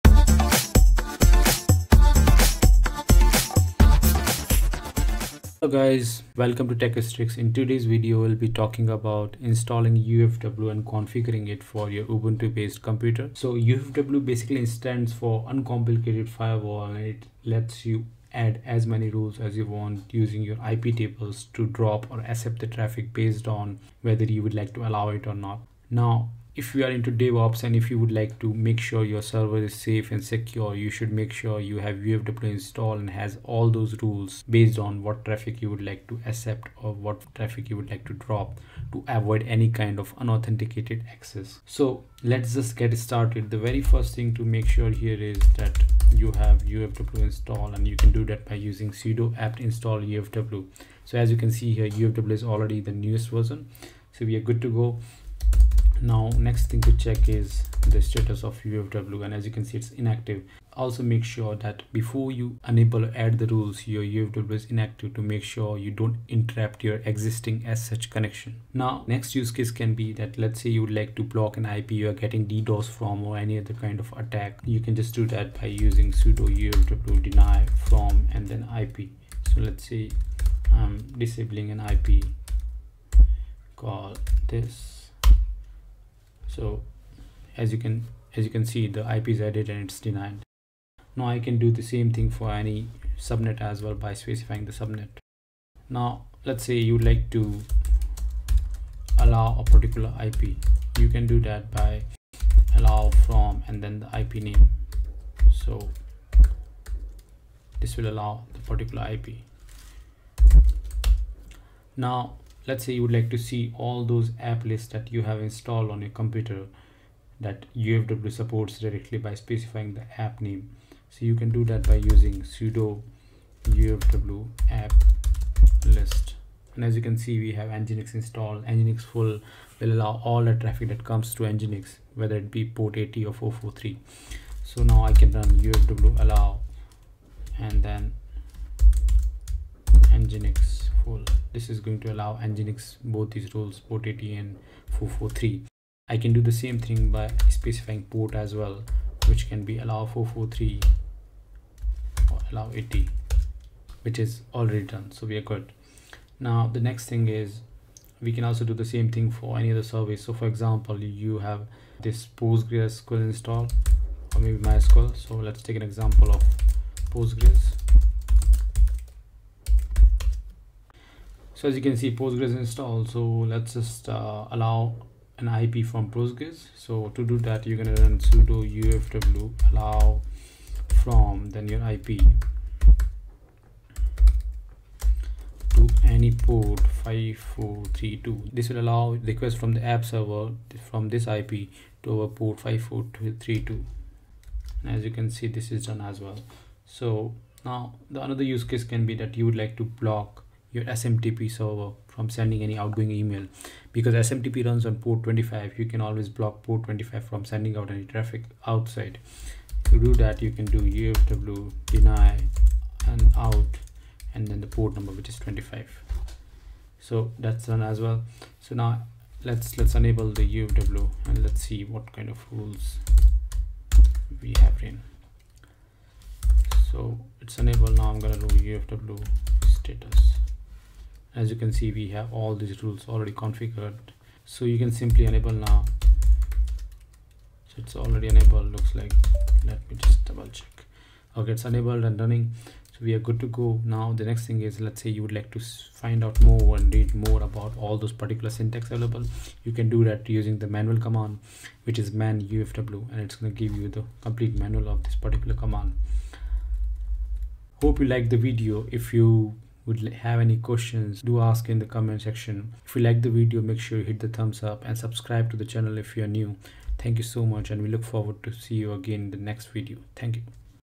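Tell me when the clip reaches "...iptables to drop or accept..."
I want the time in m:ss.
0:20.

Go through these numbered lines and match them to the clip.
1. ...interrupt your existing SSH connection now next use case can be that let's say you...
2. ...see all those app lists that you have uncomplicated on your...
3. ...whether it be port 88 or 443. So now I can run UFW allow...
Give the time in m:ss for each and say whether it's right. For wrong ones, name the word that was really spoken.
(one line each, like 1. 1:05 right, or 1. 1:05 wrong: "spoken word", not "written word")
1. 1:06 right
2. 1:53 wrong: "installed", not "uncomplicated"
3. 2:12 wrong: "80", not "88".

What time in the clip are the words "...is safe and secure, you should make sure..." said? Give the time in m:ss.
0:29.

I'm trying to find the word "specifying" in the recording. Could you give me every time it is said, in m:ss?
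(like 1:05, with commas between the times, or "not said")
1:34, 1:59, 2:27.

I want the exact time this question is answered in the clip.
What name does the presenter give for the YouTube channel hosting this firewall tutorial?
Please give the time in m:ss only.
0:06.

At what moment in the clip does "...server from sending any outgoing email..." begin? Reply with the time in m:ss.
3:21.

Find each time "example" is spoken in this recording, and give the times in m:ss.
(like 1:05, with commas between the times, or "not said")
2:40, 2:45.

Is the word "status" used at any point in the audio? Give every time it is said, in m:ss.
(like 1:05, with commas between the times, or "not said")
0:58, 3:49.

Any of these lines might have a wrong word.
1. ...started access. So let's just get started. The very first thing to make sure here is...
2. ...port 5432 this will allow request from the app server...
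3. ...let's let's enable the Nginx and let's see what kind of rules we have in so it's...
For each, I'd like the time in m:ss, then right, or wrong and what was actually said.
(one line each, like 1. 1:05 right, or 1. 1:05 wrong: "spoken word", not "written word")
1. 0:40 wrong: "unauthenticated", not "started"
2. 3:06 right
3. 3:39 wrong: "UFW", not "Nginx".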